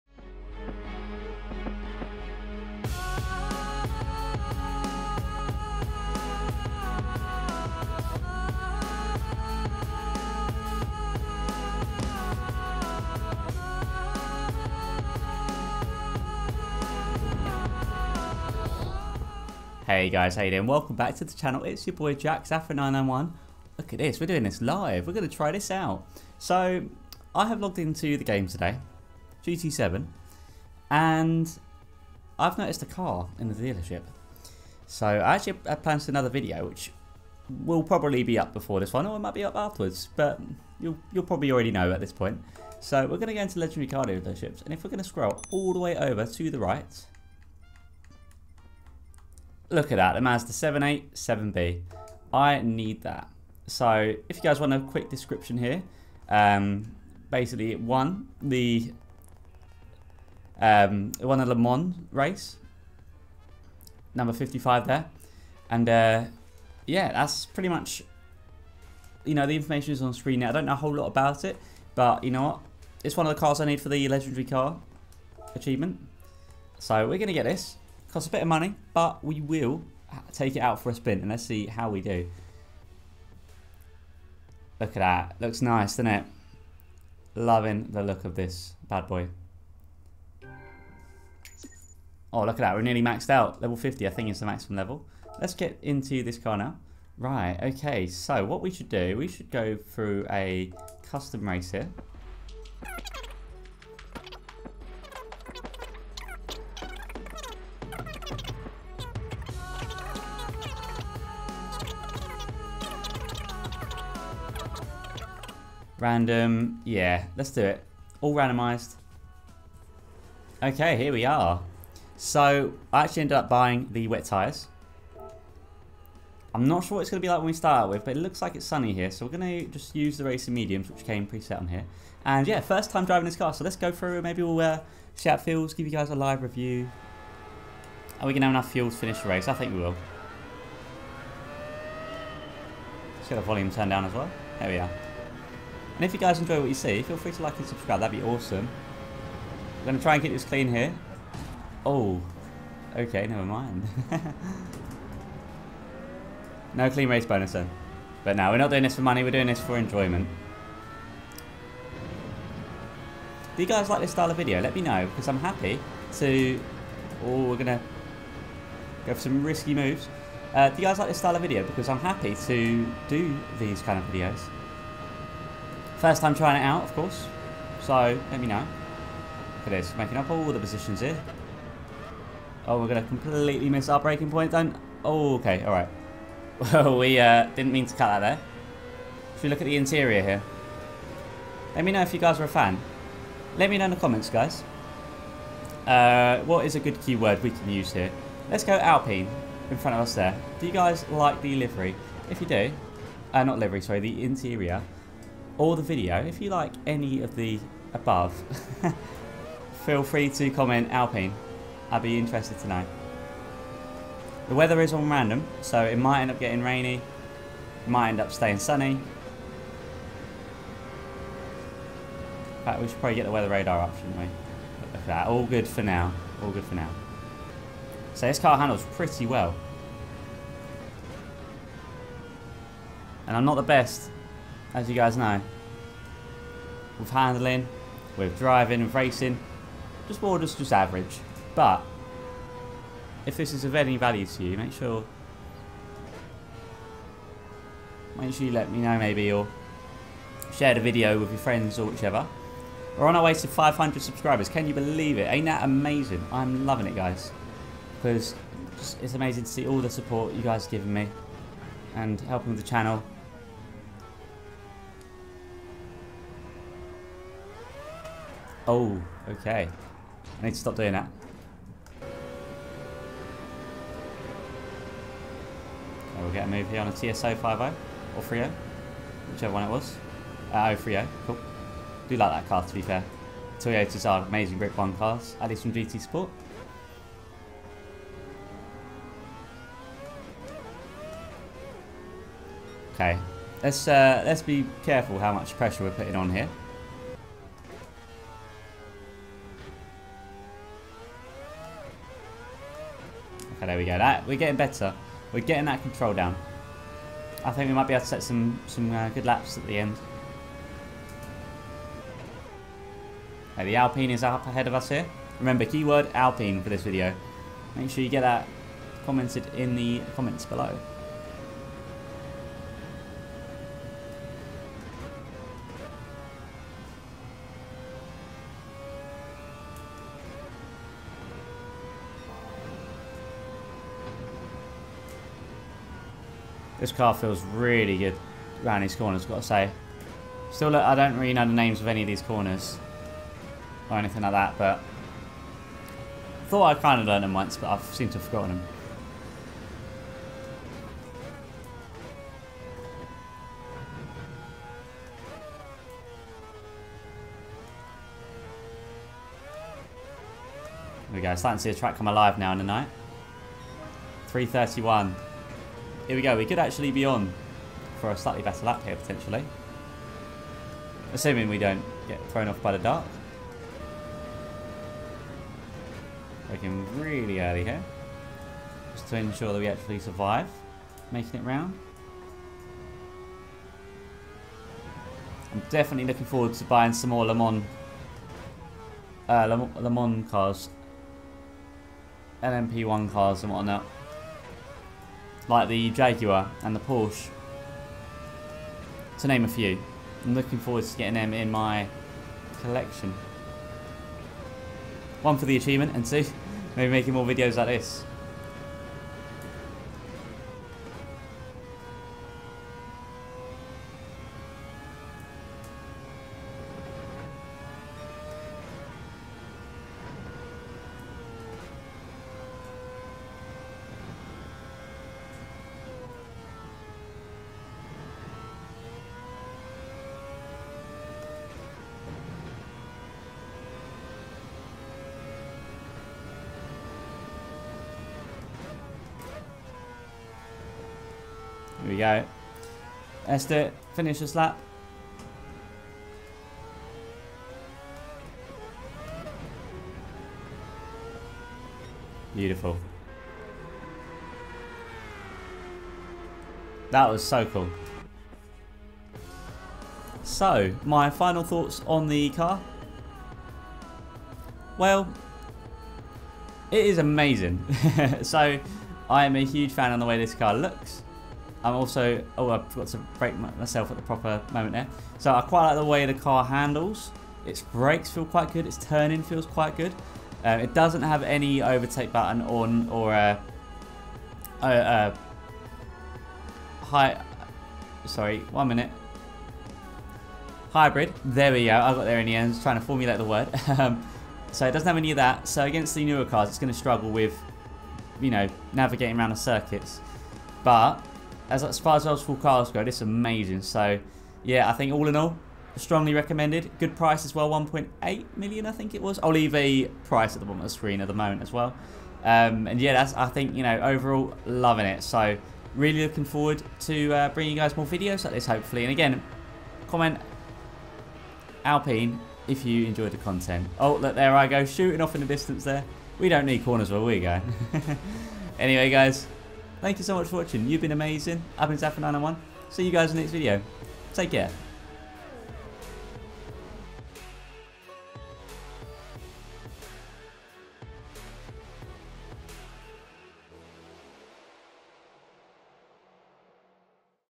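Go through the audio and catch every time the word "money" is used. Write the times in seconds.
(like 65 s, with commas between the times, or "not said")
78 s, 159 s.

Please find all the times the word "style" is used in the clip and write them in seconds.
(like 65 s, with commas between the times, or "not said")
164 s, 171 s.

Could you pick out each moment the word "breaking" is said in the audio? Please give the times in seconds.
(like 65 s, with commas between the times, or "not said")
183 s, 376 s.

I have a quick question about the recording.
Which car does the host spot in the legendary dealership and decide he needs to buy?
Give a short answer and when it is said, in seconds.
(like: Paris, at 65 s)
Mazda 787B, at 50 s.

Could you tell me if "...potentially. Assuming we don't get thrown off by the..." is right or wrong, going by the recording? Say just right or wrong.
right.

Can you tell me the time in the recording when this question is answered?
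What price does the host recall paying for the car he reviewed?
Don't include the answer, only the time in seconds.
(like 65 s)
507 s.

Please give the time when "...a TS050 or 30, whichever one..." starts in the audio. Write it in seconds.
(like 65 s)
276 s.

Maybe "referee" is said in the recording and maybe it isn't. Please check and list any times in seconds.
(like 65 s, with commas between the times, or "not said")
not said.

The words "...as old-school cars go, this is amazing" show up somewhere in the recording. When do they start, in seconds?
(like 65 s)
501 s.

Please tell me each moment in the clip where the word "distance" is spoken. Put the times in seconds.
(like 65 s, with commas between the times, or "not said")
525 s.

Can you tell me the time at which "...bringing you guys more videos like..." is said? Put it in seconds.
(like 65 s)
517 s.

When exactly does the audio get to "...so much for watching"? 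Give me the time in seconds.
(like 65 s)
530 s.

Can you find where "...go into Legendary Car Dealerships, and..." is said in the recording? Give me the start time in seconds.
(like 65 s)
43 s.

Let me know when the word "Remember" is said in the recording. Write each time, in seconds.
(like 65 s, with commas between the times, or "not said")
315 s.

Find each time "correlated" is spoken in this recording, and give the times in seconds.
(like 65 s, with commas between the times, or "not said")
not said.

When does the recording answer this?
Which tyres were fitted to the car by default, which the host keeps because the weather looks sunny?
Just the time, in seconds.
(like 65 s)
130 s.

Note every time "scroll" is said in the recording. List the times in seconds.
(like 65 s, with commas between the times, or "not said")
45 s.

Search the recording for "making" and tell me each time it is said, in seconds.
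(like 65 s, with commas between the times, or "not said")
179 s, 381 s, 406 s.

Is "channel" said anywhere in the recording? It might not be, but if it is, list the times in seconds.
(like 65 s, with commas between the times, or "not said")
21 s, 262 s.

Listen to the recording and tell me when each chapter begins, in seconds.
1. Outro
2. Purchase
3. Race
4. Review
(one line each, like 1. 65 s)
1. 534 s
2. 19 s
3. 119 s
4. 459 s.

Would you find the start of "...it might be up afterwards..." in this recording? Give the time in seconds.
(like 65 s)
39 s.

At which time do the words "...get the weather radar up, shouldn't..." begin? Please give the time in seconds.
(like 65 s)
223 s.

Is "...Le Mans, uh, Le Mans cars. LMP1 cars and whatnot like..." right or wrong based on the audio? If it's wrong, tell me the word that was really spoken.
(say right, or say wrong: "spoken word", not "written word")
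right.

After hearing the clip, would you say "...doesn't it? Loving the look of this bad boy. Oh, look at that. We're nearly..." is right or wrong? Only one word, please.
right.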